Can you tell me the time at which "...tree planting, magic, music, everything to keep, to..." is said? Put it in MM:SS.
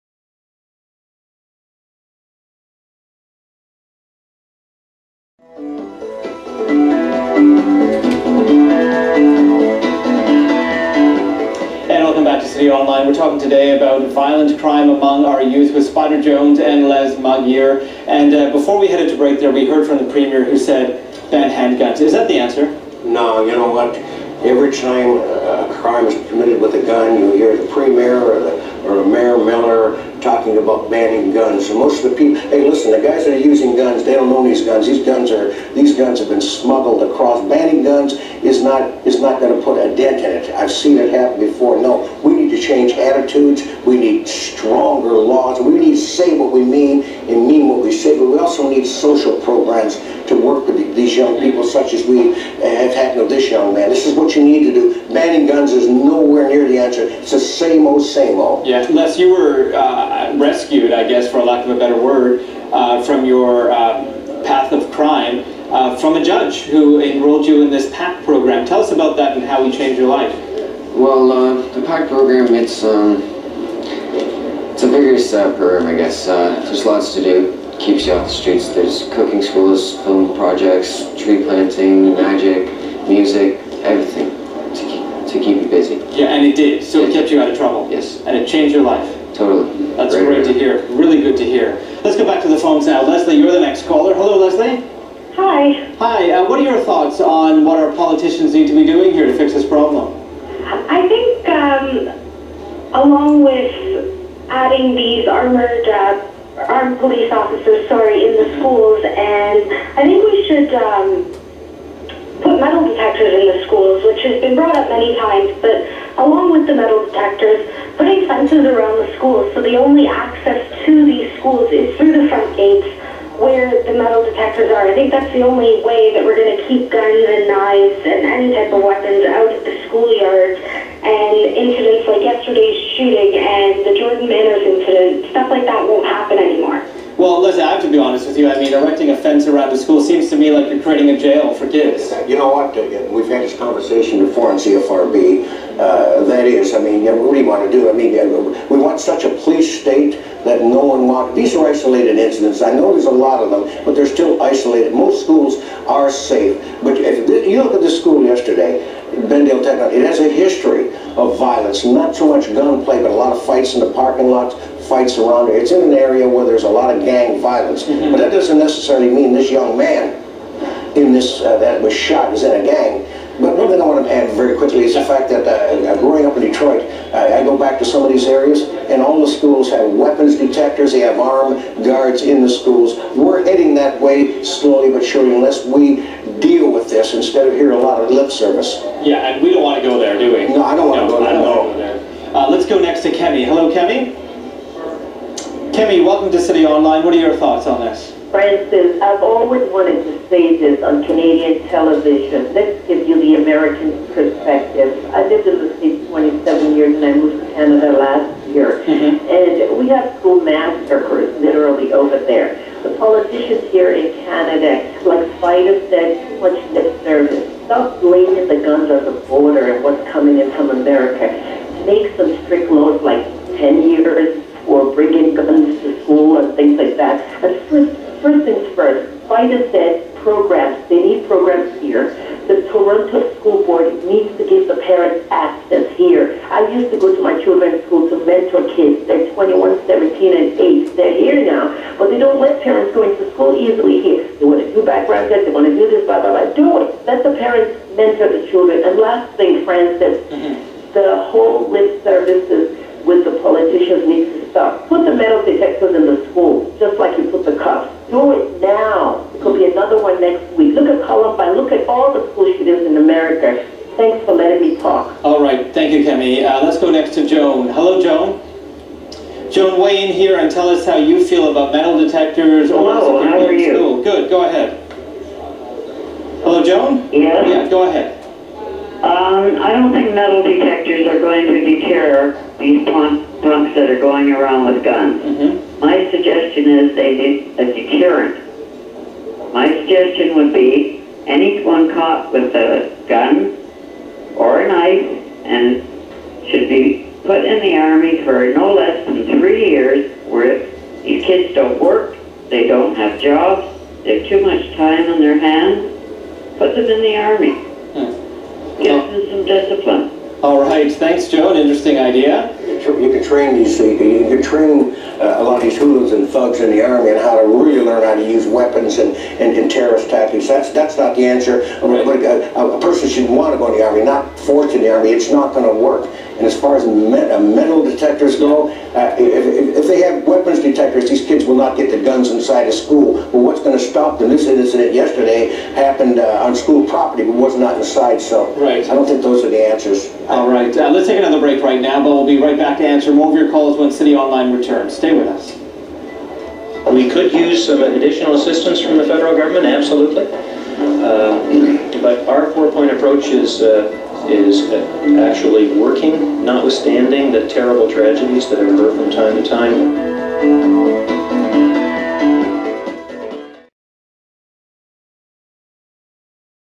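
01:21.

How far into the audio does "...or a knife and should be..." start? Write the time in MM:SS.
04:54.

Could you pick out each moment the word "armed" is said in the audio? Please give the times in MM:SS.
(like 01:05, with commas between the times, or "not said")
01:46, 03:01.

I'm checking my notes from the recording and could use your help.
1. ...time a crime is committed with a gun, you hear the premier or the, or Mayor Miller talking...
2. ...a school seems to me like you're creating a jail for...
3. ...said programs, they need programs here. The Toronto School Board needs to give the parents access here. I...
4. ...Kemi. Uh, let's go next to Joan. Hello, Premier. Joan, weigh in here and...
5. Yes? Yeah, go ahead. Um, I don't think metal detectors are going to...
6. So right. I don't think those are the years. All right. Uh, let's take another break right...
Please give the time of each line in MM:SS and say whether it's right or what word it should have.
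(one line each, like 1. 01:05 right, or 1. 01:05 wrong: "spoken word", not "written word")
1. 00:24 right
2. 02:19 right
3. 03:49 right
4. 04:26 wrong: "Joan", not "Premier"
5. 04:37 right
6. 05:38 wrong: "answers", not "years".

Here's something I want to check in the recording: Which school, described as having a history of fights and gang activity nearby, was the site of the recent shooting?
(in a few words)
Bendale Tech.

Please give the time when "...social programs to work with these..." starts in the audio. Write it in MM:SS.
00:48.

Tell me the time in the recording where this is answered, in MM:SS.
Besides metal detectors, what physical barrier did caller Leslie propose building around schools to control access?
01:58.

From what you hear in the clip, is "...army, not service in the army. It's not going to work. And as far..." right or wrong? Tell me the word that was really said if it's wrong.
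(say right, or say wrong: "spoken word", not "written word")
wrong: "force", not "service".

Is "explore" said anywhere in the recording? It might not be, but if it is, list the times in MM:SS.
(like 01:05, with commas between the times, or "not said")
not said.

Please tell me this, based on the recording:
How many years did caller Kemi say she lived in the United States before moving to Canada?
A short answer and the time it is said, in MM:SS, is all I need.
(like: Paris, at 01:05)
27, at 03:26.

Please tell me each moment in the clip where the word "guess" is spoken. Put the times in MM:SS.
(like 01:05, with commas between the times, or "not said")
01:01, 01:15.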